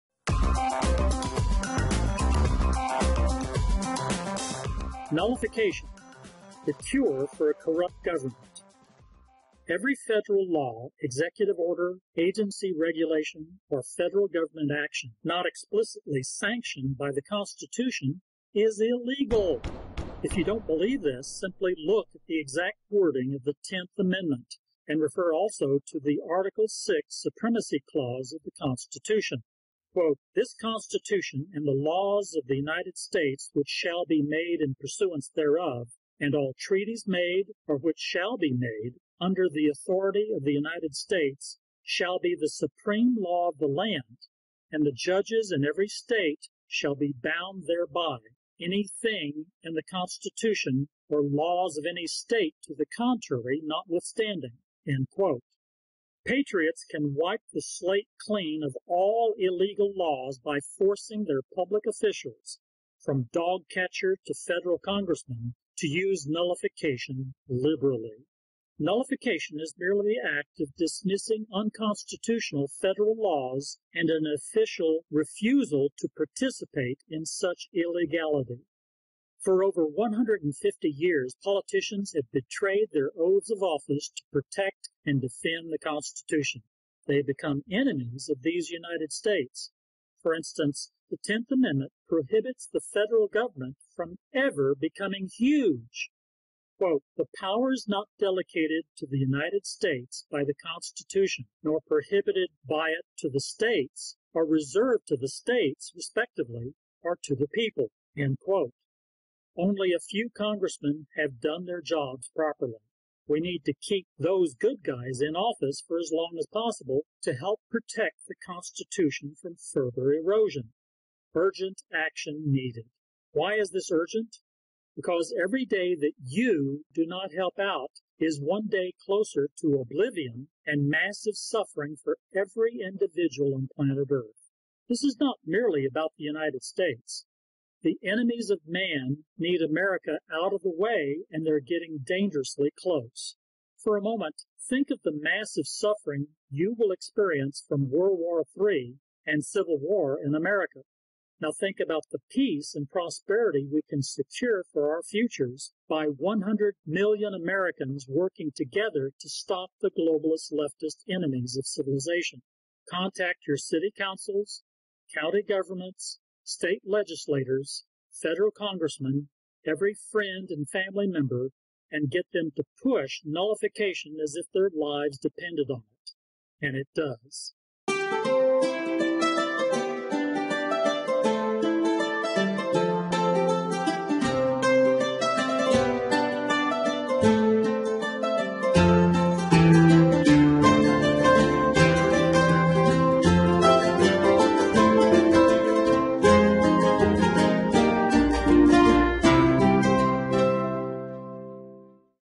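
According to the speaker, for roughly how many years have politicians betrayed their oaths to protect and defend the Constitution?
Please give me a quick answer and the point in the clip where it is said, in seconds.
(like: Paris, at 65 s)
over 150 years, at 79 s.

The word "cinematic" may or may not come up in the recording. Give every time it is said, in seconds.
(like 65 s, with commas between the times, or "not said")
not said.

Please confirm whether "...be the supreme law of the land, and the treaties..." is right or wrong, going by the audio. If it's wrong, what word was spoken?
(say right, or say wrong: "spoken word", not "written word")
wrong: "judges", not "treaties".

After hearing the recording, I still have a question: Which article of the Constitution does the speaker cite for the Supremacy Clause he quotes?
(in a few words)
Article 6.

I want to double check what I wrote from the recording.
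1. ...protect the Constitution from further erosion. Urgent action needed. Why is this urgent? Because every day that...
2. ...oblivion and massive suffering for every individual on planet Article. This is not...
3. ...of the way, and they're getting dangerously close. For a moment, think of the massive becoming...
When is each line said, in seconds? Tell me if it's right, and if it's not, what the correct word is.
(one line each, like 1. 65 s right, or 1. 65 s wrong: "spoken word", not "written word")
1. 117 s right
2. 129 s wrong: "Earth", not "Article"
3. 140 s wrong: "suffering", not "becoming".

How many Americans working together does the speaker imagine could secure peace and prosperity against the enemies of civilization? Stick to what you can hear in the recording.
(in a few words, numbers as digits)
100 million.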